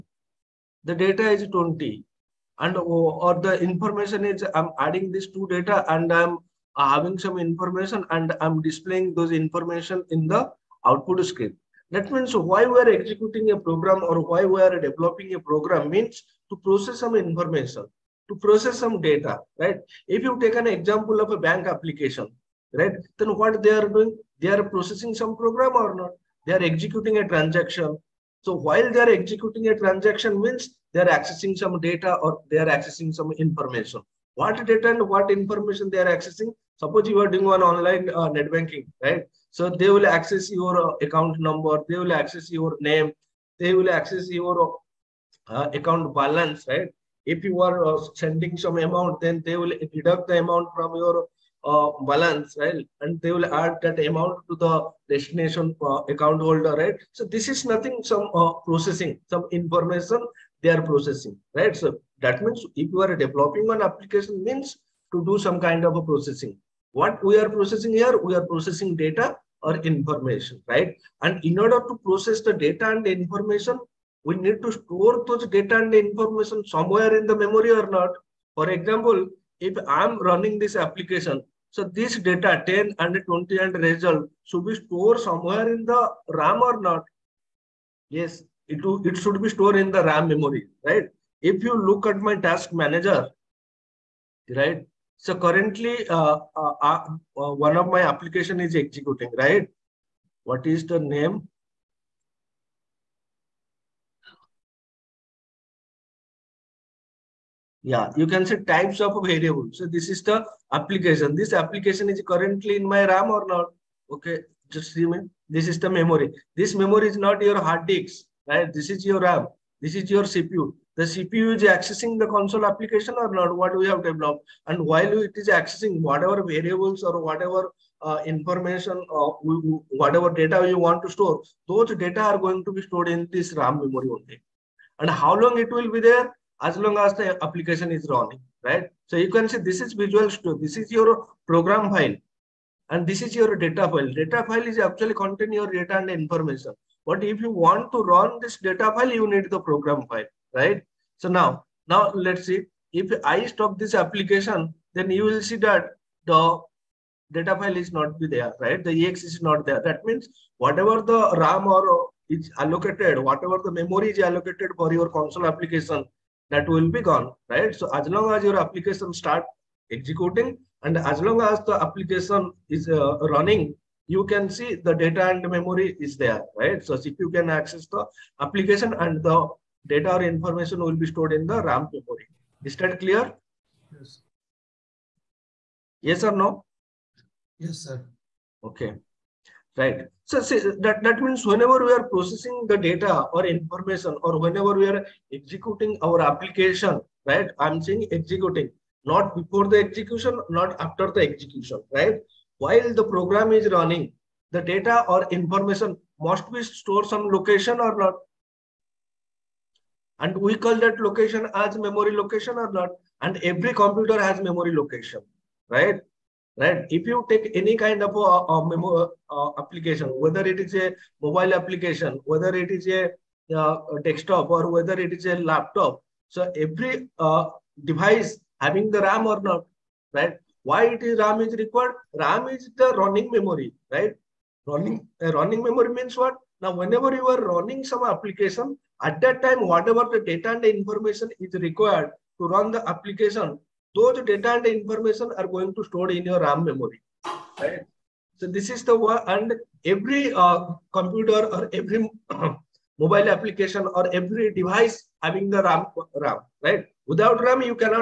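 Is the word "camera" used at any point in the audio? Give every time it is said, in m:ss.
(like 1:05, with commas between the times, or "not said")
not said.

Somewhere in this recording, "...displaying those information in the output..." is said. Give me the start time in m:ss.
0:08.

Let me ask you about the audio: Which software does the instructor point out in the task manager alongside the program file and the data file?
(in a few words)
Visual Studio.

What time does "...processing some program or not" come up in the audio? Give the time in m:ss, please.
0:24.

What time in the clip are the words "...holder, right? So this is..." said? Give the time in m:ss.
0:56.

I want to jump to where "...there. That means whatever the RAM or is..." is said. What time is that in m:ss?
2:39.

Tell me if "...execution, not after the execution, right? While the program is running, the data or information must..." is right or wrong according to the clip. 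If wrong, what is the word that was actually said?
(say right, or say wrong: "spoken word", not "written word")
right.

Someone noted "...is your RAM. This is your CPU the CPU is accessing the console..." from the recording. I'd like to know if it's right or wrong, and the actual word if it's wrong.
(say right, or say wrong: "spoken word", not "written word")
right.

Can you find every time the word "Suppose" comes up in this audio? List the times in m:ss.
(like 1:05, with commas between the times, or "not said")
0:36.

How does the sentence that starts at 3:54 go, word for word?
Running uh, running memory means what?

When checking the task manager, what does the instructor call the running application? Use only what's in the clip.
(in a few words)
types of variable.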